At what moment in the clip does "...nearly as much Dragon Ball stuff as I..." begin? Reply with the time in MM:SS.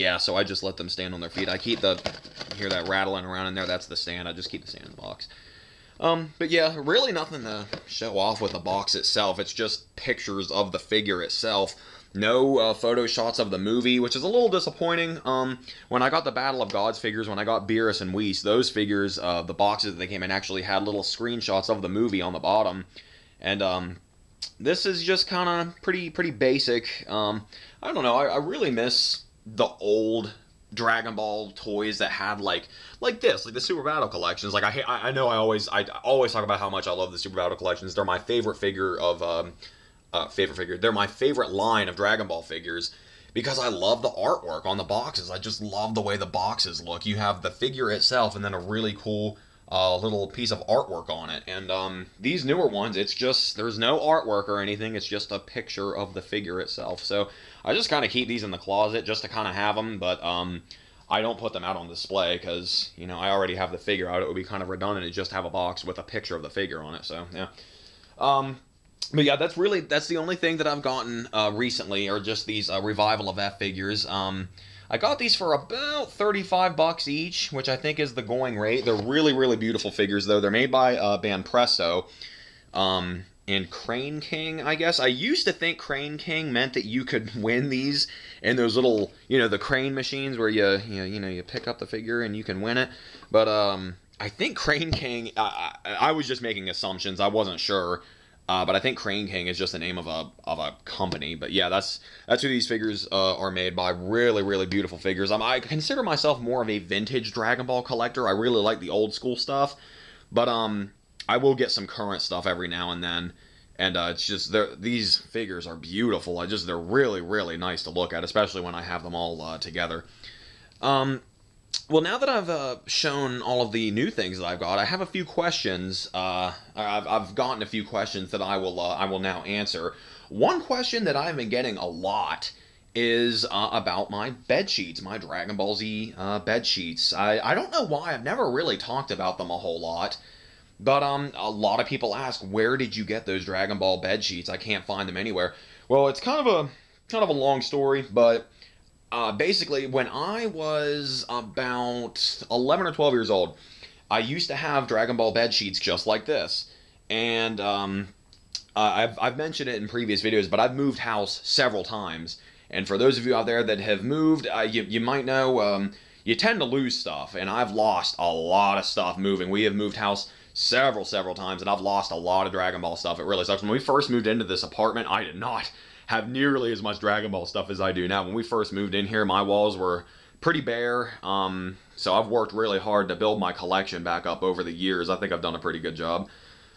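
02:56.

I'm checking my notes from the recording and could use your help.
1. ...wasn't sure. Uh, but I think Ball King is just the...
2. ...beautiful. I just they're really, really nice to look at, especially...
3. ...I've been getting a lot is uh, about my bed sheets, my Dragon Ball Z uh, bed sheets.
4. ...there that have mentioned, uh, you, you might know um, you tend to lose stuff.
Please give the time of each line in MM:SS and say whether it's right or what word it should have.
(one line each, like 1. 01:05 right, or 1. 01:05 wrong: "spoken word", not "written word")
1. 01:37 wrong: "Crane", not "Ball"
2. 01:55 right
3. 02:11 right
4. 02:43 wrong: "moved", not "mentioned".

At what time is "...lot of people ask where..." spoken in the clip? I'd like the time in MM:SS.
02:21.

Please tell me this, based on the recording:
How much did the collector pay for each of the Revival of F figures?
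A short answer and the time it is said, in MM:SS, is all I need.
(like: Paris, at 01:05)
$35, at 01:16.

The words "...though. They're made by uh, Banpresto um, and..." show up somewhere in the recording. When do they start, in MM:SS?
01:20.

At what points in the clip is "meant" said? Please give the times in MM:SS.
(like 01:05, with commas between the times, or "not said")
01:26.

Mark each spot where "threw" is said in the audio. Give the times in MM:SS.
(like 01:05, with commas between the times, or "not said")
not said.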